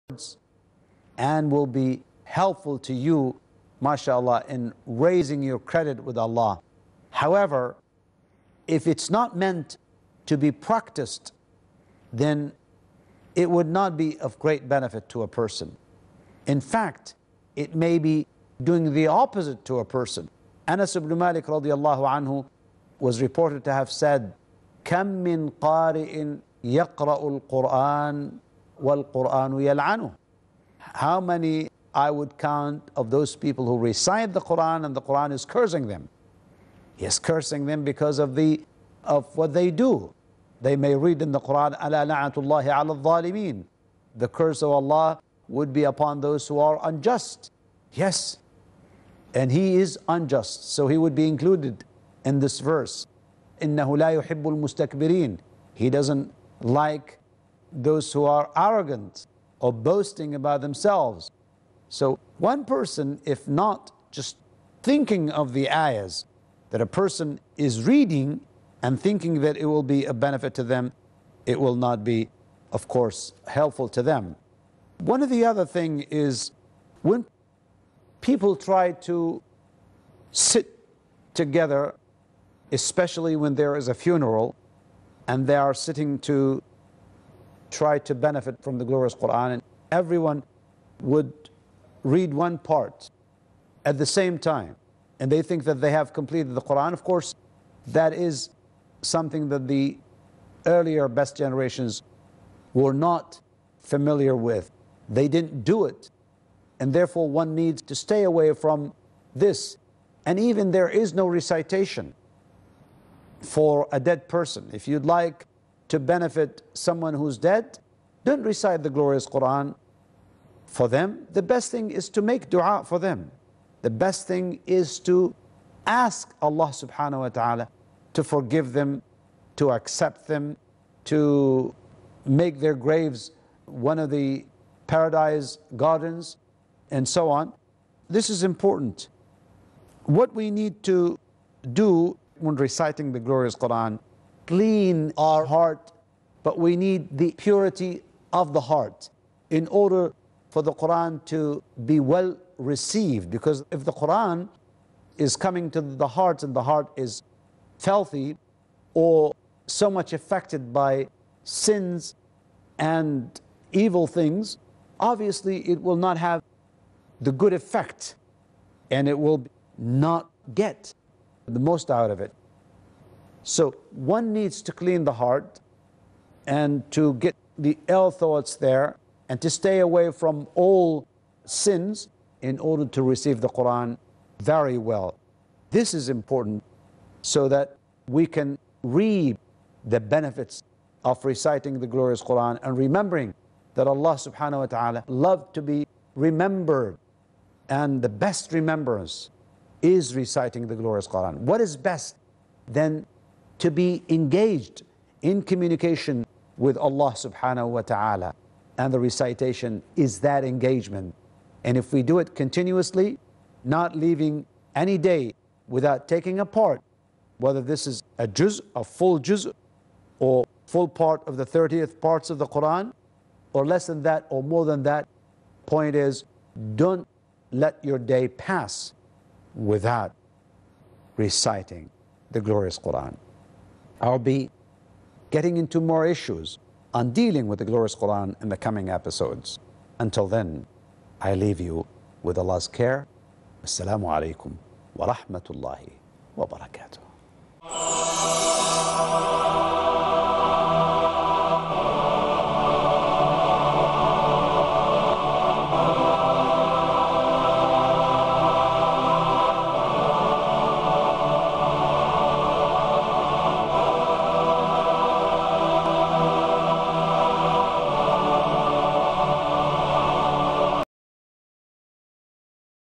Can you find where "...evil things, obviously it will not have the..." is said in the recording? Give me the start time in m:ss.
2:43.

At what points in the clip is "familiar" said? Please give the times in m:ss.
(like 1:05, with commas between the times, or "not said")
1:43.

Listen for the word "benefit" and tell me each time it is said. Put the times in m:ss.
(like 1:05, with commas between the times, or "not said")
0:14, 1:10, 1:28, 1:55, 3:09.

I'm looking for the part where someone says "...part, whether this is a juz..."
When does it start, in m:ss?
3:36.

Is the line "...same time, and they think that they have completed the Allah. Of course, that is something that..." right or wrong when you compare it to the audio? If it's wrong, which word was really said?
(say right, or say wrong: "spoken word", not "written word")
wrong: "Quran", not "Allah".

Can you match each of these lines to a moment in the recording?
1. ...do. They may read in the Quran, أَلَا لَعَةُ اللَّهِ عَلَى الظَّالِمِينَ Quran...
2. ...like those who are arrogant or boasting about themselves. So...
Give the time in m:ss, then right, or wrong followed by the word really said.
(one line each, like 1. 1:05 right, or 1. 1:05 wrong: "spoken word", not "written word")
1. 0:39 wrong: "The", not "Quran"
2. 0:56 right.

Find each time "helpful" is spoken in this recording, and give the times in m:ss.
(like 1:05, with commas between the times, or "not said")
0:02, 1:13.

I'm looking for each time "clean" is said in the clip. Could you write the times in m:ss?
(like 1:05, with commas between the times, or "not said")
2:24, 2:54.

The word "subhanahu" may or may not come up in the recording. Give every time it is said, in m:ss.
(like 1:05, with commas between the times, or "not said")
2:06, 3:14, 3:27.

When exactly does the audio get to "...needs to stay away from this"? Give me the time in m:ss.
1:47.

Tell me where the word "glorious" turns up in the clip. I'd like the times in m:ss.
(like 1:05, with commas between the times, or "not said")
1:28, 1:58, 2:23, 3:11, 3:20, 3:52, 3:57.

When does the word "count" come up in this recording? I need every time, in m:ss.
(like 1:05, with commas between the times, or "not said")
0:32.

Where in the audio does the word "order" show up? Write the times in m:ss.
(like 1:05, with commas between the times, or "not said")
2:29, 3:02.